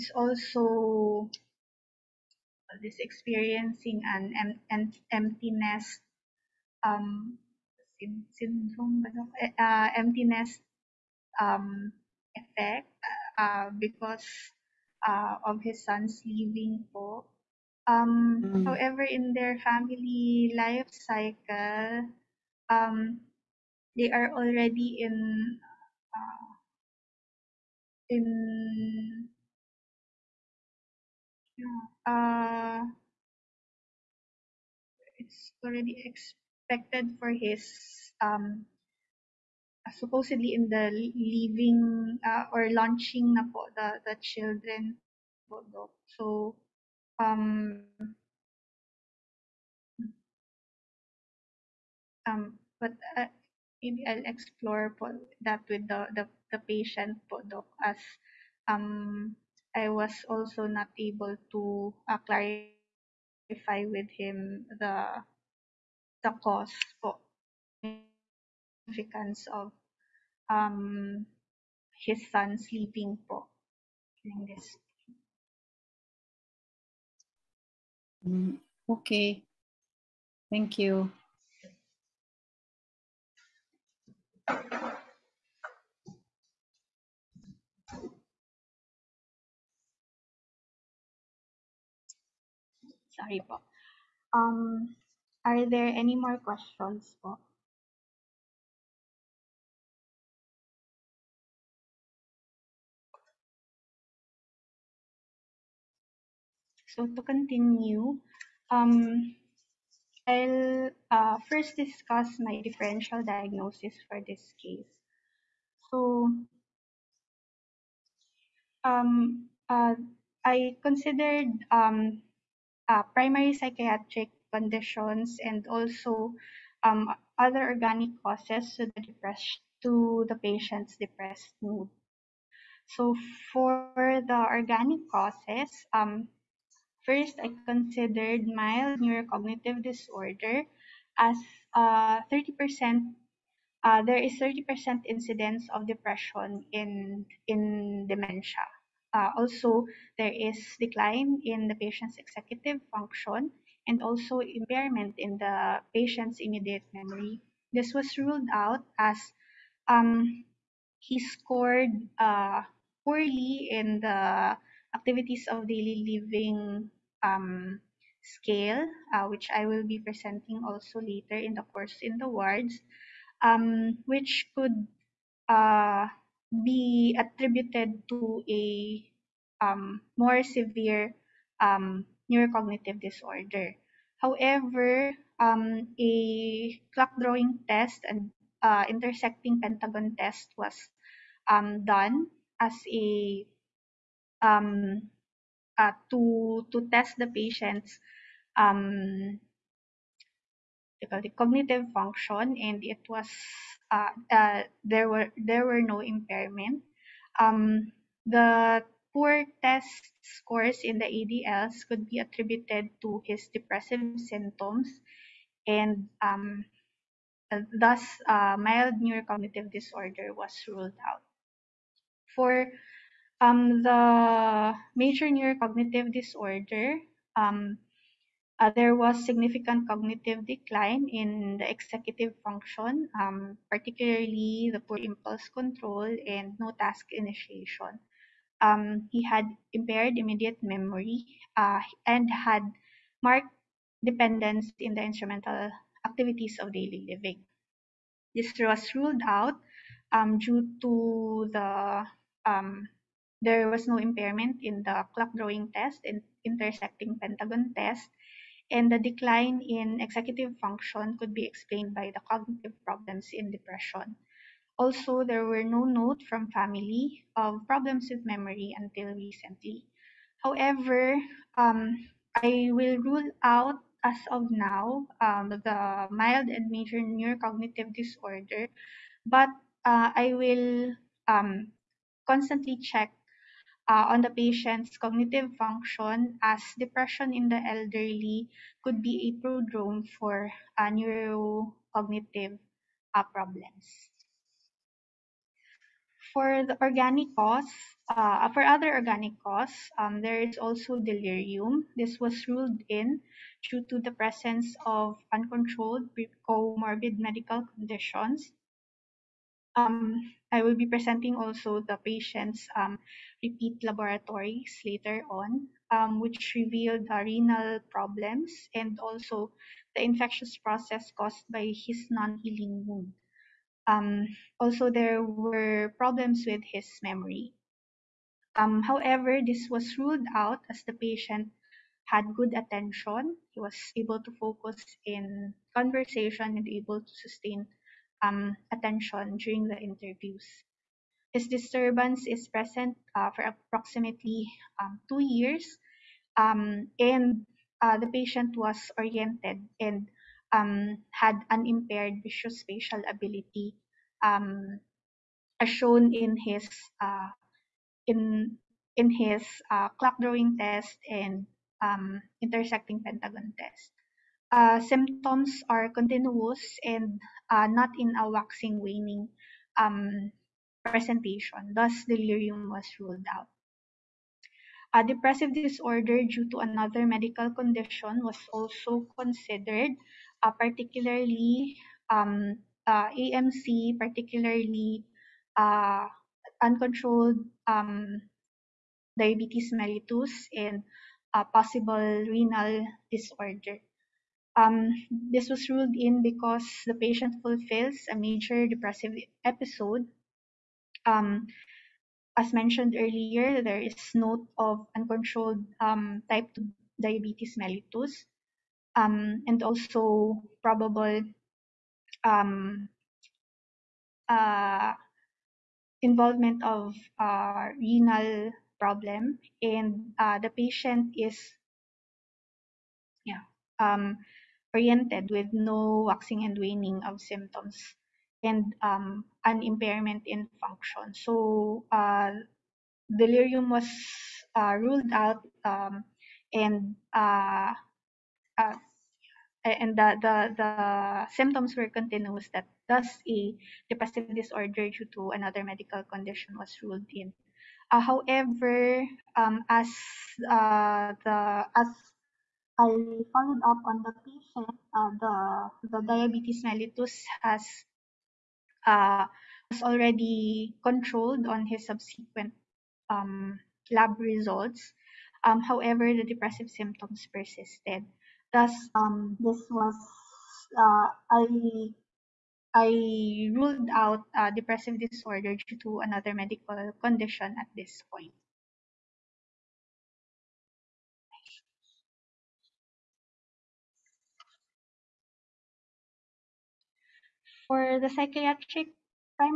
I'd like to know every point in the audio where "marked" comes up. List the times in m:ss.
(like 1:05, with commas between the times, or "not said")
4:03.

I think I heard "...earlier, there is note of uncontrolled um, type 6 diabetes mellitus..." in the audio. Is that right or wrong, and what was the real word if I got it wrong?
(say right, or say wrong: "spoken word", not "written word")
wrong: "2", not "6".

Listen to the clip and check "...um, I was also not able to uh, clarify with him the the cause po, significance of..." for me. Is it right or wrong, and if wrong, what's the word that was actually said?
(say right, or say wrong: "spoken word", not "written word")
right.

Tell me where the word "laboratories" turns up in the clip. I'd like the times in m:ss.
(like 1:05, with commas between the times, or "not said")
5:13.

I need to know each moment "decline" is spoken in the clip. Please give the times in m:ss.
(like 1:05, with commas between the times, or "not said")
2:30, 3:50, 4:19.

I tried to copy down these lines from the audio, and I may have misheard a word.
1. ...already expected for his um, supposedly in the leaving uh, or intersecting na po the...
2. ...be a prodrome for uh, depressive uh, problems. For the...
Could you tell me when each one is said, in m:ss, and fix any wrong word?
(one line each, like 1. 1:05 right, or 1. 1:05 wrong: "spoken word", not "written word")
1. 0:35 wrong: "launching", not "intersecting"
2. 4:49 wrong: "neurocognitive", not "depressive".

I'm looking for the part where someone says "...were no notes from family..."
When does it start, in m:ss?
4:25.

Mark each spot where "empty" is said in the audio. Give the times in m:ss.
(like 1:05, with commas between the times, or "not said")
0:05, 0:09.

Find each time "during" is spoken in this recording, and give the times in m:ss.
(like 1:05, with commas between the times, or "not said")
1:14, 5:39.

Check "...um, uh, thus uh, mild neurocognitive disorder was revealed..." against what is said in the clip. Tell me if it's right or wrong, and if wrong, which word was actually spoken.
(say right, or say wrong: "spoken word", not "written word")
wrong: "ruled", not "revealed".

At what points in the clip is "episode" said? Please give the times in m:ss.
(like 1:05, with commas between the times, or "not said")
6:39.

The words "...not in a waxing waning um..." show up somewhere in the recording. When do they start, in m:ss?
6:07.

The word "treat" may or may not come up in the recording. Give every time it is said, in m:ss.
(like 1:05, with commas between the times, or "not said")
not said.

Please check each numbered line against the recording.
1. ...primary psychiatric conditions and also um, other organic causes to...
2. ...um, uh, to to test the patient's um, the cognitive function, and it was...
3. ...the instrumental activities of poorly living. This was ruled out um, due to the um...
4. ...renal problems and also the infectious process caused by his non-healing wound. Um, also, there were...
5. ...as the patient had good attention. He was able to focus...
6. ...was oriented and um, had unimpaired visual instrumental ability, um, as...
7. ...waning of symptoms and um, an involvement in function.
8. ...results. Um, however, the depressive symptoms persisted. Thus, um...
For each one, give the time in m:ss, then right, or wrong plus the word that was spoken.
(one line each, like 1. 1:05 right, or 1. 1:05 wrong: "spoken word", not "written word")
1. 2:03 right
2. 3:14 right
3. 4:04 wrong: "daily", not "poorly"
4. 5:17 right
5. 5:30 right
6. 5:48 wrong: "spatial", not "instrumental"
7. 7:06 wrong: "impairment", not "involvement"
8. 7:44 right.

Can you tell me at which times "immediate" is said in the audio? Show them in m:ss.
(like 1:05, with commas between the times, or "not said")
2:36, 4:00.